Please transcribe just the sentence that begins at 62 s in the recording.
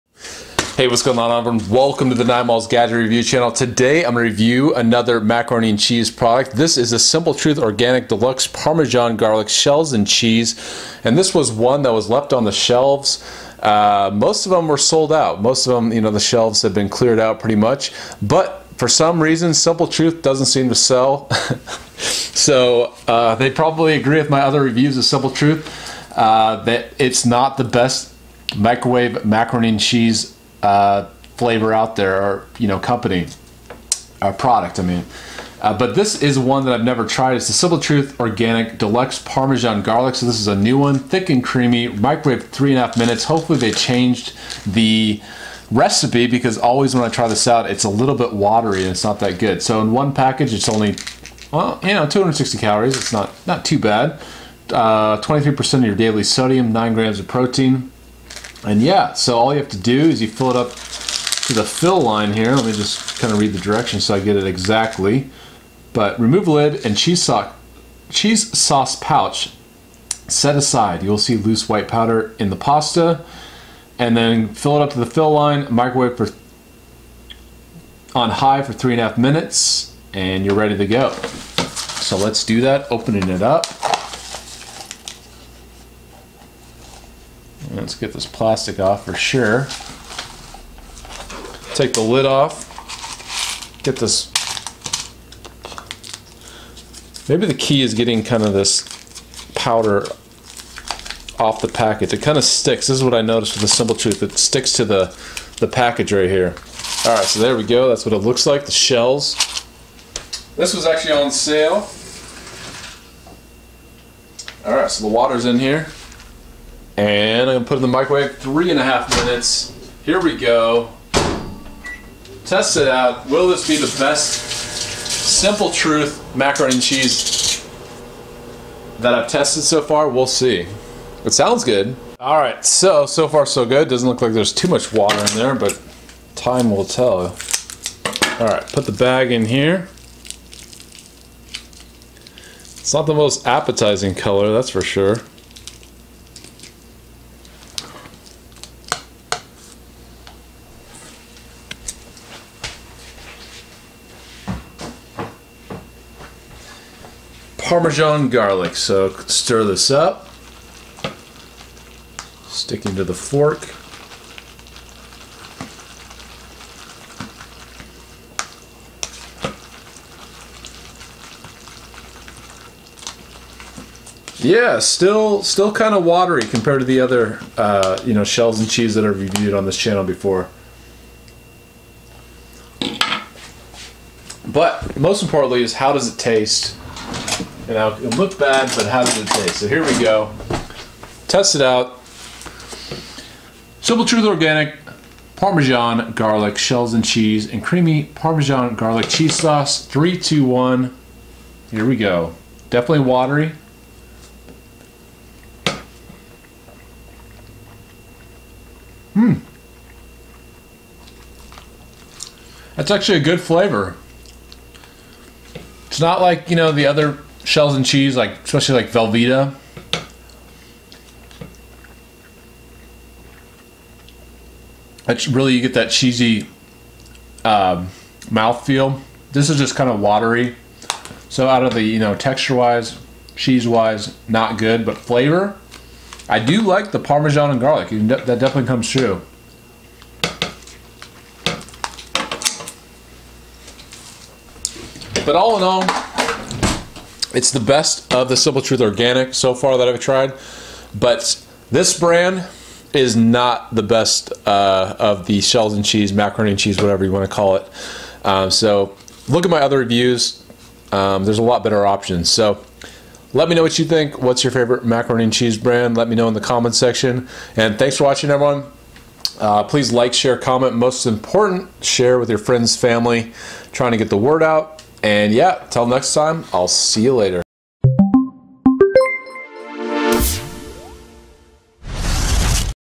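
Let me just kind of read the directions so I get it exactly.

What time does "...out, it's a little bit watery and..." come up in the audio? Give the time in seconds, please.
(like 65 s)
47 s.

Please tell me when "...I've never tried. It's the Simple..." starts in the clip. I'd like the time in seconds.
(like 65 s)
36 s.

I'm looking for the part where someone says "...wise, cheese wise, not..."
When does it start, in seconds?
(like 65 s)
232 s.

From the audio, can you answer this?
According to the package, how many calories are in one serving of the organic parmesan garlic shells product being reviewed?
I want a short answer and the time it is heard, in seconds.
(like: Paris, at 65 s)
260, at 52 s.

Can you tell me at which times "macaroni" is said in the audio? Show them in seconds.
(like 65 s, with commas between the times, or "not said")
5 s, 29 s, 126 s, 256 s, 264 s.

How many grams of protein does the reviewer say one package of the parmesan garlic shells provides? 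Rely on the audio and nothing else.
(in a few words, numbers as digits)
9 grams.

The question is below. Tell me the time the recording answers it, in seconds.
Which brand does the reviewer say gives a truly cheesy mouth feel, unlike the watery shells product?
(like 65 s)
218 s.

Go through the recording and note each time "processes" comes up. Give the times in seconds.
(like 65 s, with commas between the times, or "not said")
not said.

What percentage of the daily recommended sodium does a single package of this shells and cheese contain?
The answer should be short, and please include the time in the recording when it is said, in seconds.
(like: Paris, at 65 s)
23%, at 54 s.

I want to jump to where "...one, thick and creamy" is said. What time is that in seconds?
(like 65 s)
40 s.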